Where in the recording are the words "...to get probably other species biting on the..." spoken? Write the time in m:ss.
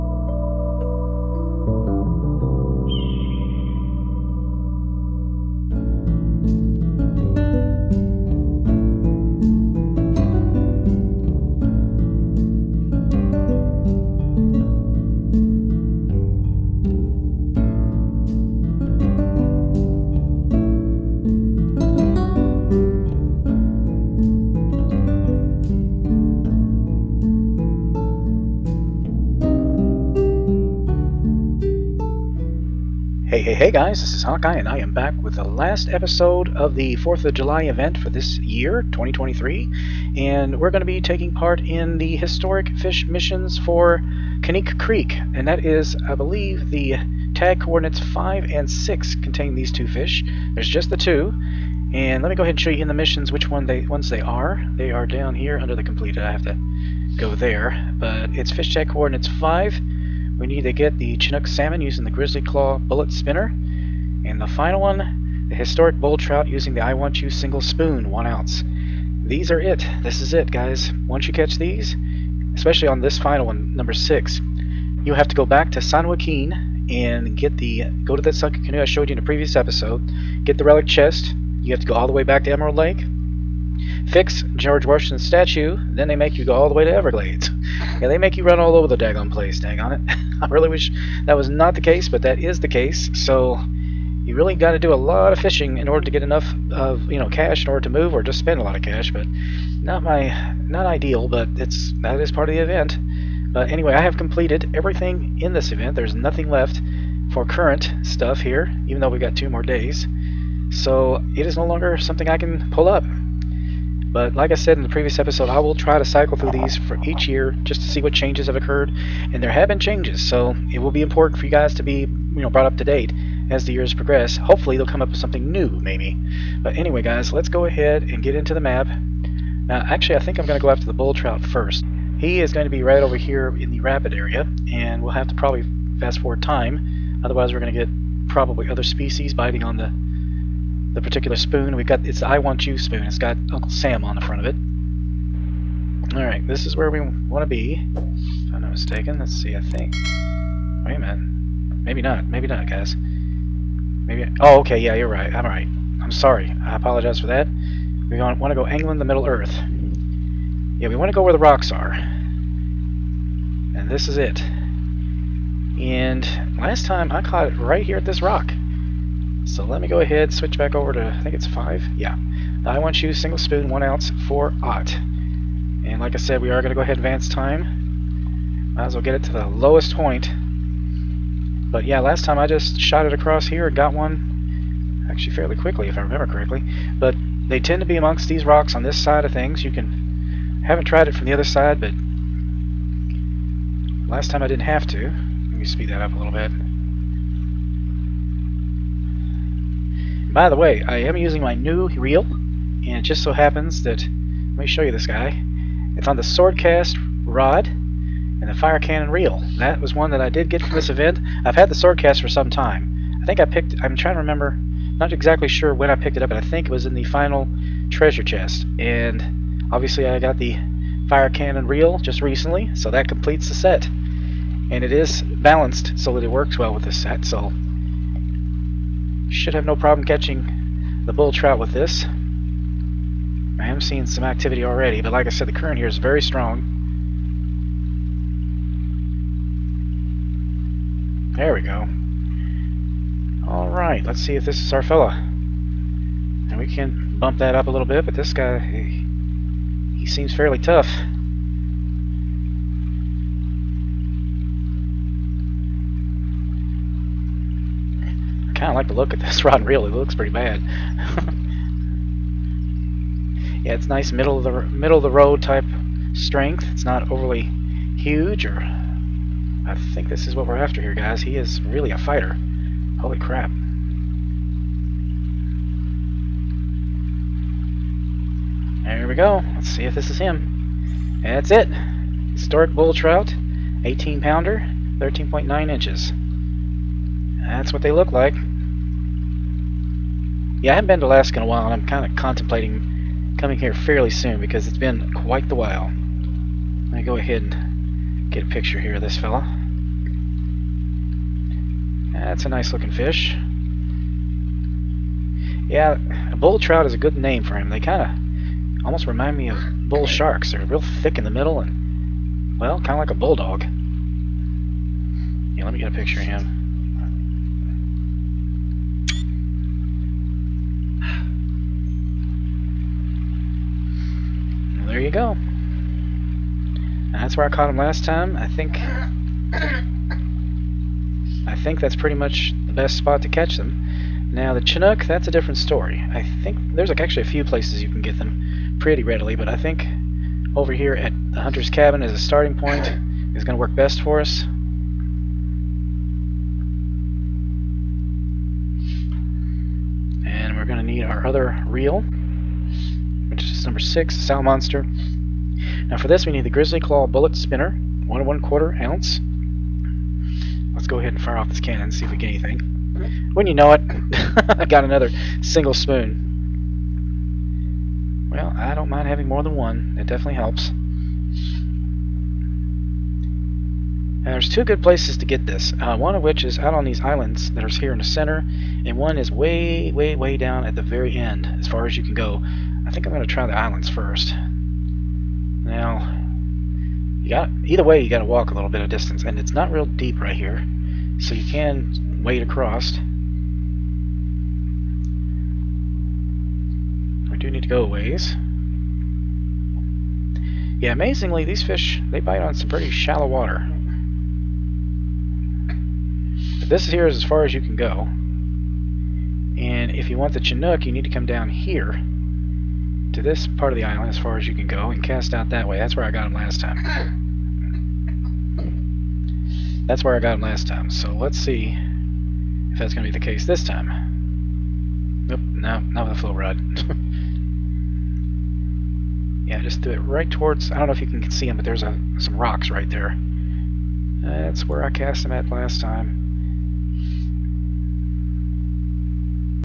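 2:17.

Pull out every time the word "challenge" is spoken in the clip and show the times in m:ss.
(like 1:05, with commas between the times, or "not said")
not said.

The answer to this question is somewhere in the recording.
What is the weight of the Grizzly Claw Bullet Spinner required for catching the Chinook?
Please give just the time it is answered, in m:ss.
5:58.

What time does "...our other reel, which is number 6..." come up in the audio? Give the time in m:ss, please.
5:51.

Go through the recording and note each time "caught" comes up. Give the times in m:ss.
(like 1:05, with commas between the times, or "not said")
2:47, 5:27.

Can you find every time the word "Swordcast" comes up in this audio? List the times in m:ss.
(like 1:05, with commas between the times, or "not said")
3:26, 3:31.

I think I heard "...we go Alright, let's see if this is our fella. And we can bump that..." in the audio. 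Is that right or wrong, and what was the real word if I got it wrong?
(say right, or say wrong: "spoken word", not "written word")
right.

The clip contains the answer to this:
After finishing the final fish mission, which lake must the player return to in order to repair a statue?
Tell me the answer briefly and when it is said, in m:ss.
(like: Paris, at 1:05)
Emerald Lake, at 1:22.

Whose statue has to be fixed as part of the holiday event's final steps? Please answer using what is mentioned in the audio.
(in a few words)
George Washington.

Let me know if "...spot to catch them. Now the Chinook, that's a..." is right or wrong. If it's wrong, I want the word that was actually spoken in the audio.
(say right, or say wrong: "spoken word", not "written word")
right.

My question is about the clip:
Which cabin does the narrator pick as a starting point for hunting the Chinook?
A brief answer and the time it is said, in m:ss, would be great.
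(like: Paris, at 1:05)
Hunter's cabin, at 5:41.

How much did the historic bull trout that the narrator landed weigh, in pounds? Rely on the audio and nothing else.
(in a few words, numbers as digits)
18.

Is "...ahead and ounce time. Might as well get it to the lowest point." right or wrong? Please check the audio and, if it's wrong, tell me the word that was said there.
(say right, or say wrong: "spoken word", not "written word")
wrong: "advance", not "ounce".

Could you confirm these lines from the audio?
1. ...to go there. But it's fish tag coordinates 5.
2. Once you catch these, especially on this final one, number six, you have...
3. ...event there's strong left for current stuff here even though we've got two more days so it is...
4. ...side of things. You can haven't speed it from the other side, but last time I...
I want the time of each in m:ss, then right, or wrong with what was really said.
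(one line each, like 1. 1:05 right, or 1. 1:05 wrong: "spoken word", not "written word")
1. 0:56 right
2. 1:11 right
3. 1:45 wrong: "nothing", not "strong"
4. 3:08 wrong: "tried", not "speed".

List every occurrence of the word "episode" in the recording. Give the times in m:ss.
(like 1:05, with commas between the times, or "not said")
0:35, 1:19, 1:55.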